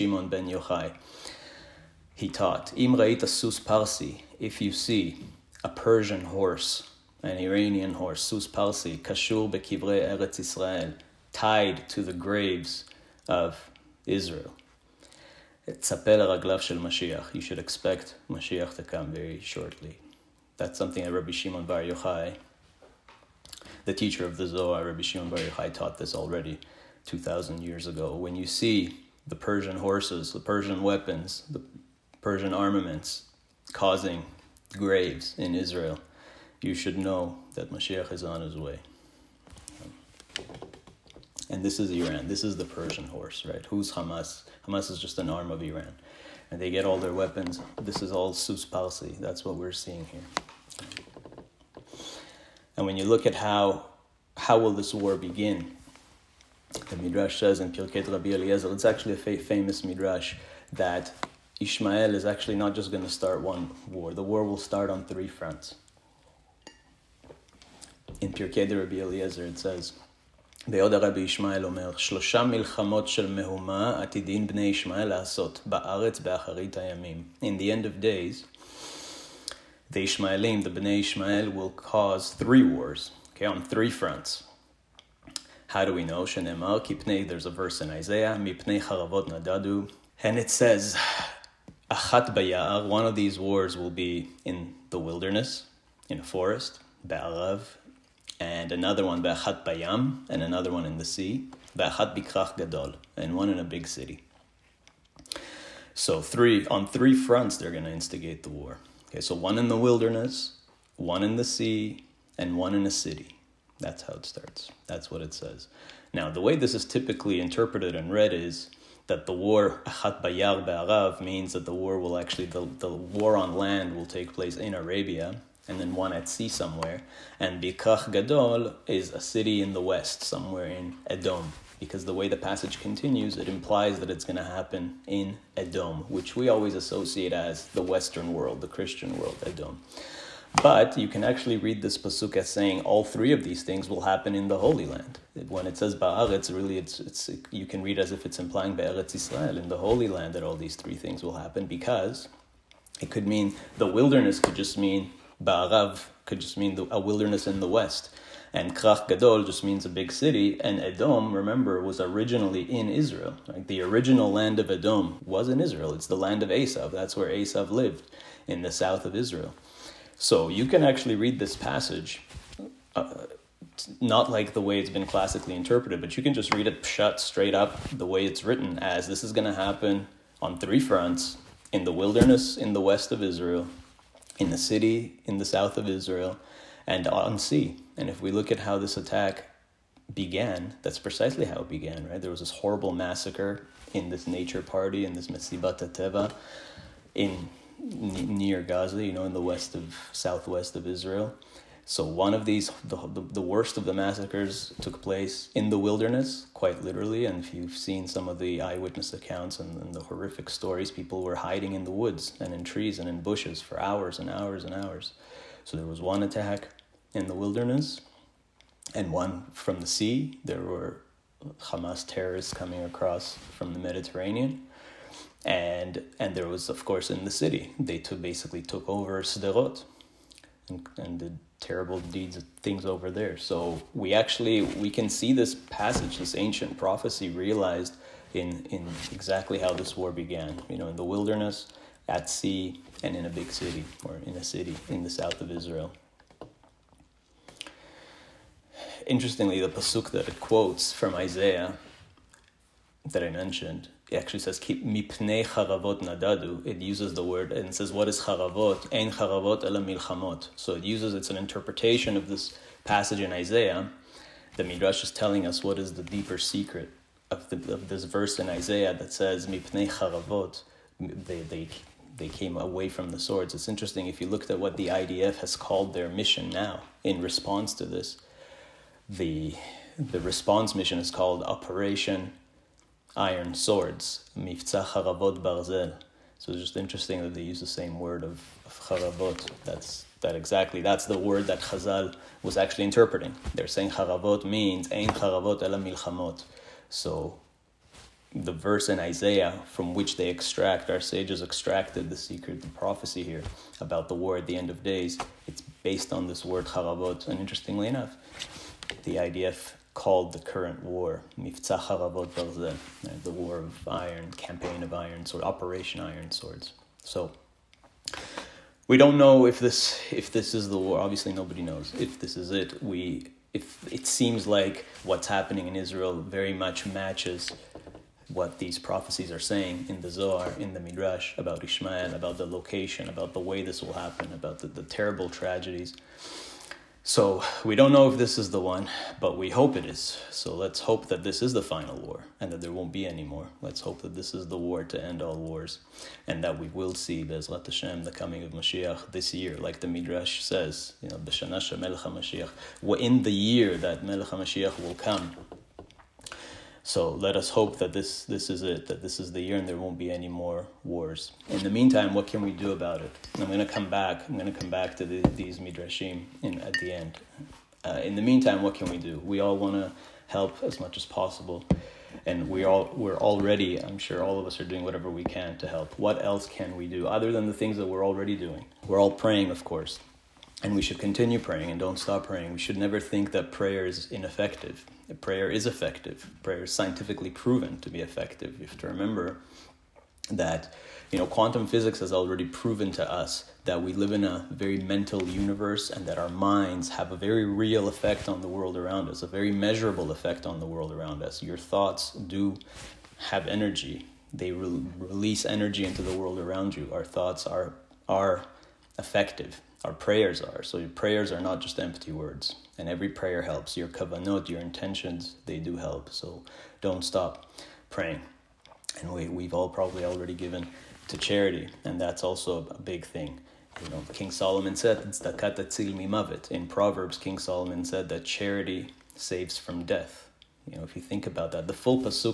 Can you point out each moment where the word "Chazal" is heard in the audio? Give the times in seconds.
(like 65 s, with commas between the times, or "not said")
291 s.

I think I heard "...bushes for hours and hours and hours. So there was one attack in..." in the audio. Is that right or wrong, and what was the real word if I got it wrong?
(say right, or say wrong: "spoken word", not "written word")
right.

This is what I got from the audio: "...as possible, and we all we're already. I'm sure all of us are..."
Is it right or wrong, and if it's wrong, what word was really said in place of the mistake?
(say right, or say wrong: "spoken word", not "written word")
right.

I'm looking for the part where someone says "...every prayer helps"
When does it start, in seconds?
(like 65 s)
412 s.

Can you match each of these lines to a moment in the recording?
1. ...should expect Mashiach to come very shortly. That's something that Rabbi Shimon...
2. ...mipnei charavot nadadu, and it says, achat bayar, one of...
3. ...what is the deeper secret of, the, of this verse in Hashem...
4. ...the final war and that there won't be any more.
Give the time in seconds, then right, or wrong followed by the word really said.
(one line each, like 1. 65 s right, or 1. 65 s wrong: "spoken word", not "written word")
1. 17 s right
2. 88 s wrong: "haravot", not "charavot"
3. 265 s wrong: "Isaiah", not "Hashem"
4. 341 s right.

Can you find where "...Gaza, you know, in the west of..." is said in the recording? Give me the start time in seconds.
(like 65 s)
198 s.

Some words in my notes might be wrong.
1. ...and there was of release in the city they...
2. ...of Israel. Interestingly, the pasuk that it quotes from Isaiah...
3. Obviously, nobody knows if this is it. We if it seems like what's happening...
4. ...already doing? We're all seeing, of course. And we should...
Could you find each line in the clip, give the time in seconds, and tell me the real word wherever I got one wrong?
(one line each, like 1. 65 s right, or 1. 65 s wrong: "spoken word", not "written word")
1. 226 s wrong: "course", not "release"
2. 245 s right
3. 320 s right
4. 378 s wrong: "praying", not "seeing".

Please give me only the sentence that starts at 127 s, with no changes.
And Bikrach Gadol is a city in the west, somewhere in Edom.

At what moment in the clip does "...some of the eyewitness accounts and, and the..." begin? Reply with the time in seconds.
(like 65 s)
208 s.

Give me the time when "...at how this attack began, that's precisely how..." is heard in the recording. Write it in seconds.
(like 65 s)
188 s.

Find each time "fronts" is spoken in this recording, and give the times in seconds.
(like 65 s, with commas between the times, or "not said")
65 s, 83 s, 107 s, 180 s.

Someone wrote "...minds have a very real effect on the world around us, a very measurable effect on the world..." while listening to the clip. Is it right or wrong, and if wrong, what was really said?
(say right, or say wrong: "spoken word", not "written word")
right.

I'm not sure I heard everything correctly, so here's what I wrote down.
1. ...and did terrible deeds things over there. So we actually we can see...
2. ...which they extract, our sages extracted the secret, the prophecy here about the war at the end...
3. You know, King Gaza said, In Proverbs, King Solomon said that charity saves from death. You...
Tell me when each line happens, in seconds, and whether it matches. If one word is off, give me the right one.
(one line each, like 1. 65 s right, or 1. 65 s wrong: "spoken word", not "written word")
1. 230 s right
2. 299 s right
3. 423 s wrong: "Solomon", not "Gaza".